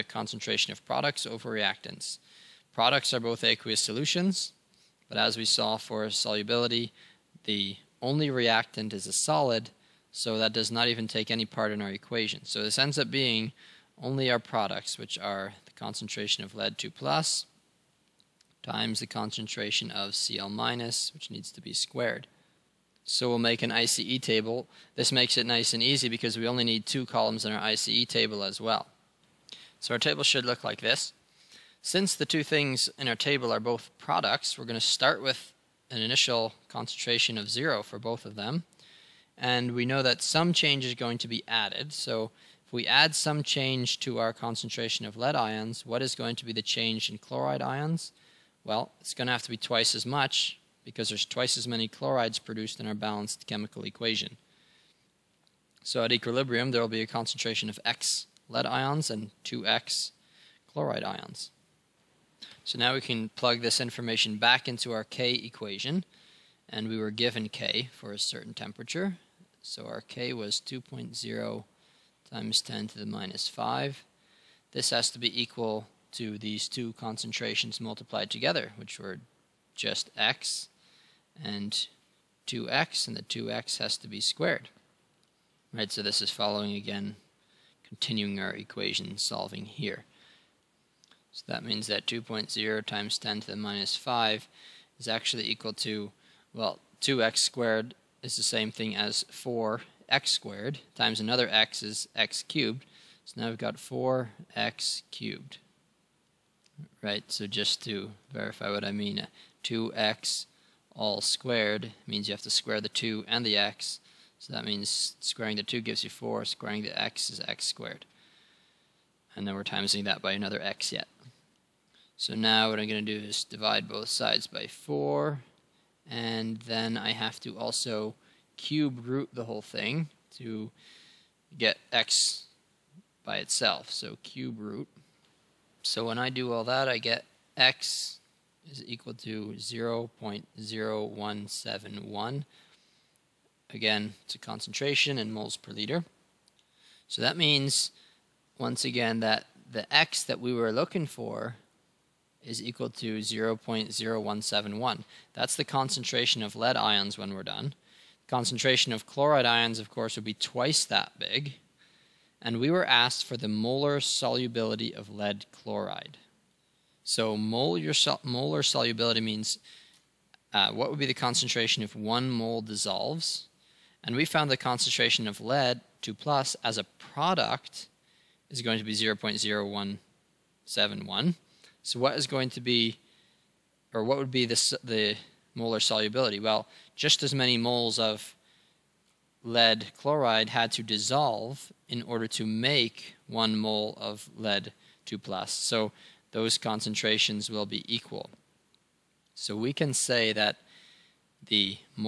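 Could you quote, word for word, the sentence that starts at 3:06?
Well, just as many moles of lead chloride had to dissolve in order to make one mole of lead 2 plus.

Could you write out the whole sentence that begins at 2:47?
So mole your molar solubility means uh, what would be the concentration if one mole dissolves?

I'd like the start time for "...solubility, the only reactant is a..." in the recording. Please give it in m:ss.
0:06.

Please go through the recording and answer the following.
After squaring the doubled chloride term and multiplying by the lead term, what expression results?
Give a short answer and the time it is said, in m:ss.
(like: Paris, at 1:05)
4x cubed, at 1:43.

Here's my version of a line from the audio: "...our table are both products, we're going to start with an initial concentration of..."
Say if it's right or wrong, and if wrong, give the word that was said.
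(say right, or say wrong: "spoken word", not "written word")
right.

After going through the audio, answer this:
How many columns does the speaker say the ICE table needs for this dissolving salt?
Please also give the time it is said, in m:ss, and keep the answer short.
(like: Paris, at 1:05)
2, at 0:26.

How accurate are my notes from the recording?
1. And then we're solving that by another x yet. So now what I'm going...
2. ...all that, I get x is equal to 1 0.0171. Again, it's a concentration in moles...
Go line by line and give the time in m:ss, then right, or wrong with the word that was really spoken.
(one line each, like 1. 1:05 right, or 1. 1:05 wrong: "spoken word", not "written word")
1. 1:59 wrong: "timesing", not "solving"
2. 2:16 wrong: "0", not "1".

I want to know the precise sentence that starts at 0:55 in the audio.
So at equilibrium, there will be a concentration of X lead ions and 2X chloride ions.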